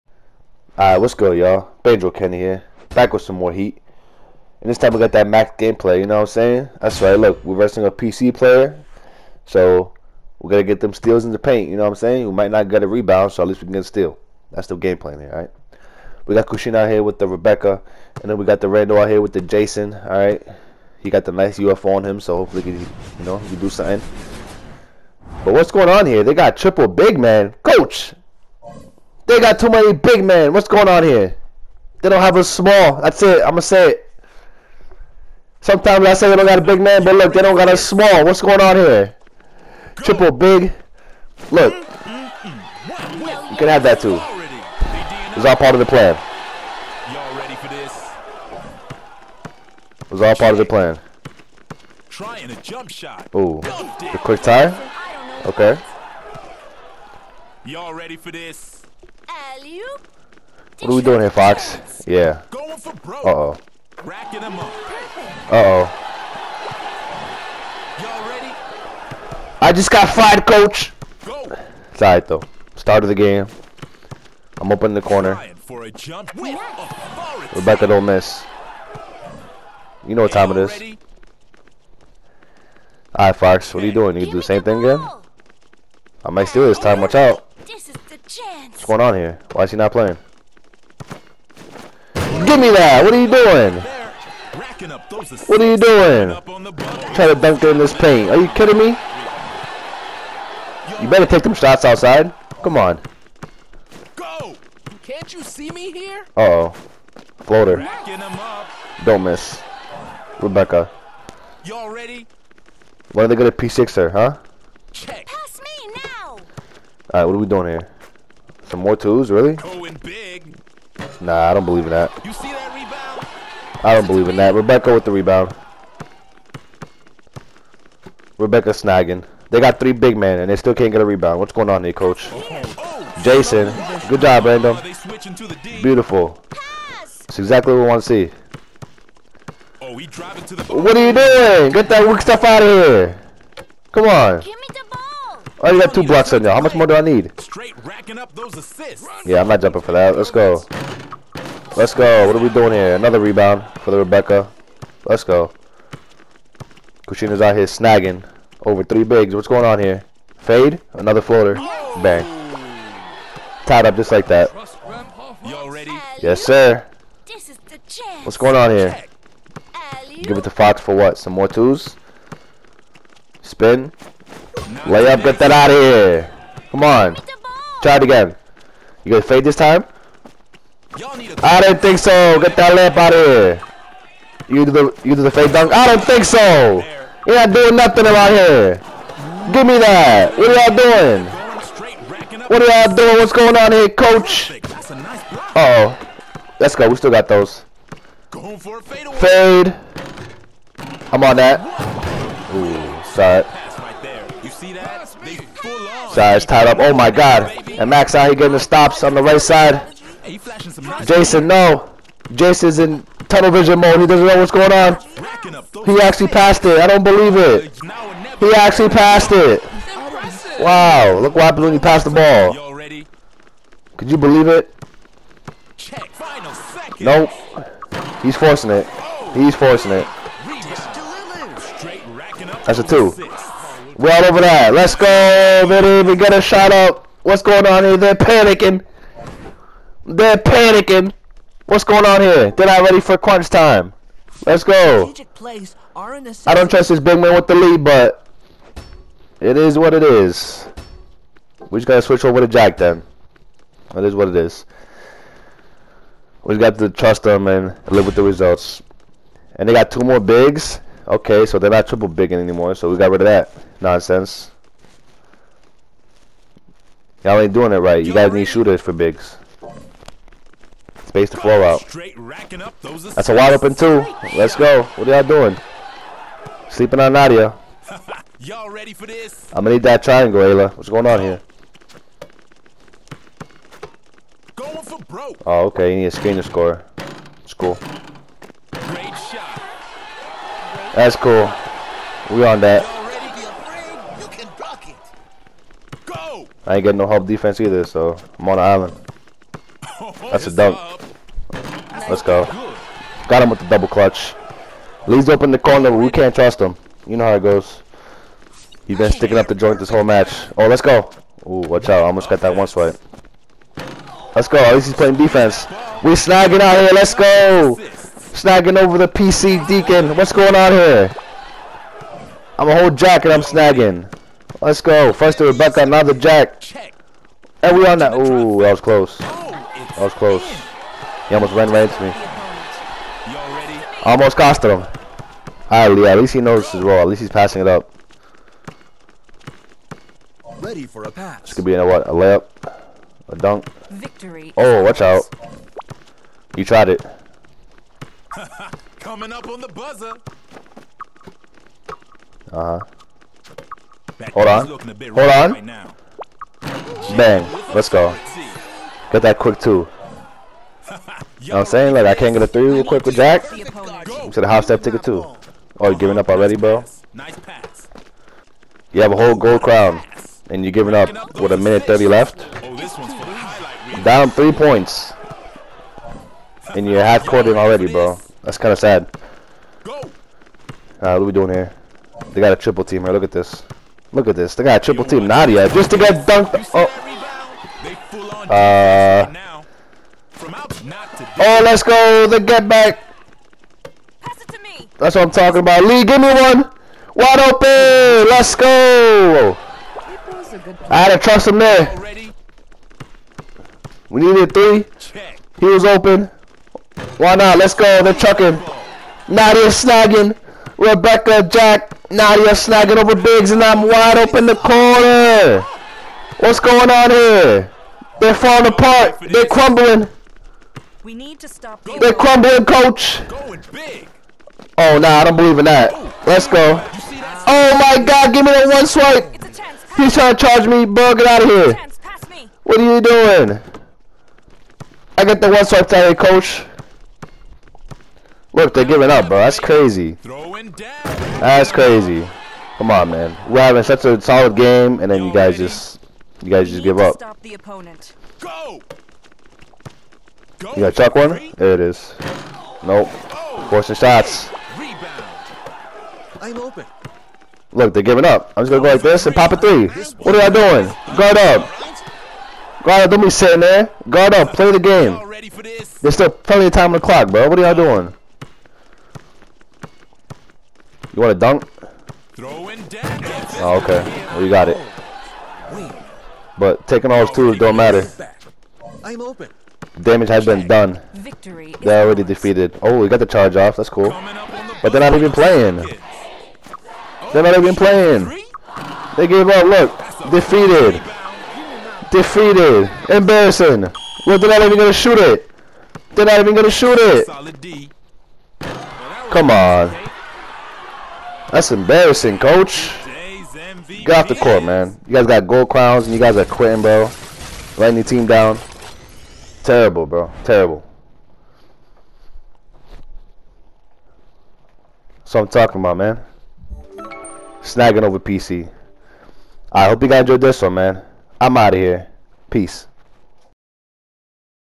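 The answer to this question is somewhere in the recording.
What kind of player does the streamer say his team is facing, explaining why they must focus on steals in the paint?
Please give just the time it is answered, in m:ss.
0:07.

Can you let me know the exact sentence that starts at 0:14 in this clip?
That's the game plan here, alright?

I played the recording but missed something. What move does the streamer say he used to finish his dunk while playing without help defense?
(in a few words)
Double clutch.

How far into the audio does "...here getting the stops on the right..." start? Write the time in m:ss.
3:28.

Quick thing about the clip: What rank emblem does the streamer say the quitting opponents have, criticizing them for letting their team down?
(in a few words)
Gold crowns.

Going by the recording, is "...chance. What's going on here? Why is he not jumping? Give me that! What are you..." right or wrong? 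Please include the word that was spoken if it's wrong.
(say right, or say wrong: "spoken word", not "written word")
wrong: "playing", not "jumping".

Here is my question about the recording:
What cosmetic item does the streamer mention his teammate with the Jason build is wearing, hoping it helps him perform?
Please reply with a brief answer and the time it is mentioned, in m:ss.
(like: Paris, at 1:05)
UFO, at 0:21.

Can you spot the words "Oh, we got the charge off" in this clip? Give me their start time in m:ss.
8:02.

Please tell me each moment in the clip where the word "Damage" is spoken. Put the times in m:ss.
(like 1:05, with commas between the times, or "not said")
8:00.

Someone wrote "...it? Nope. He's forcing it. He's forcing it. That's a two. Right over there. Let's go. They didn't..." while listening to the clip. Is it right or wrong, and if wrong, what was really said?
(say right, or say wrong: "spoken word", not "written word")
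right.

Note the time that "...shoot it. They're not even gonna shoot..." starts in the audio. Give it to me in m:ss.
8:14.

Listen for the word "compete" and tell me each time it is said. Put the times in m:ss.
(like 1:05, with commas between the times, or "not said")
not said.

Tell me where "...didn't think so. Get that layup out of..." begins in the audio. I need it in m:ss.
3:01.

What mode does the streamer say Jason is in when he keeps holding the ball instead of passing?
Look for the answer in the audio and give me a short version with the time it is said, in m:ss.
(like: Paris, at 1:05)
Tunnel vision mode, at 3:33.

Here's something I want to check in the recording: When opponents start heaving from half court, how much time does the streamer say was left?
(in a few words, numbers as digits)
A minute 30.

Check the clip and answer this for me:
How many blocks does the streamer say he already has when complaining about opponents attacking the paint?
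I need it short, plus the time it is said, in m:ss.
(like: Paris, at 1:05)
2, at 2:25.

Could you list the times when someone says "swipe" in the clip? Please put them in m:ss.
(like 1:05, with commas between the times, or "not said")
5:12, 7:08, 7:15.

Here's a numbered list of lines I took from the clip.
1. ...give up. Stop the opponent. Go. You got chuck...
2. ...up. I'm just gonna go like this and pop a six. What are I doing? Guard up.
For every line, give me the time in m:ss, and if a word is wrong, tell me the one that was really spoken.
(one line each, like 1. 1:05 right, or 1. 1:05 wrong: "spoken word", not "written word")
1. 7:26 right
2. 7:38 wrong: "three", not "six".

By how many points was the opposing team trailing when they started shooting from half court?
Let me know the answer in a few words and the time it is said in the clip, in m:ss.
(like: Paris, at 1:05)
3, at 6:14.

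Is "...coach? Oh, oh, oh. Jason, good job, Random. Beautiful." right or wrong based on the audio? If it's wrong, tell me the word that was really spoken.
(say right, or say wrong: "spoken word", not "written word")
right.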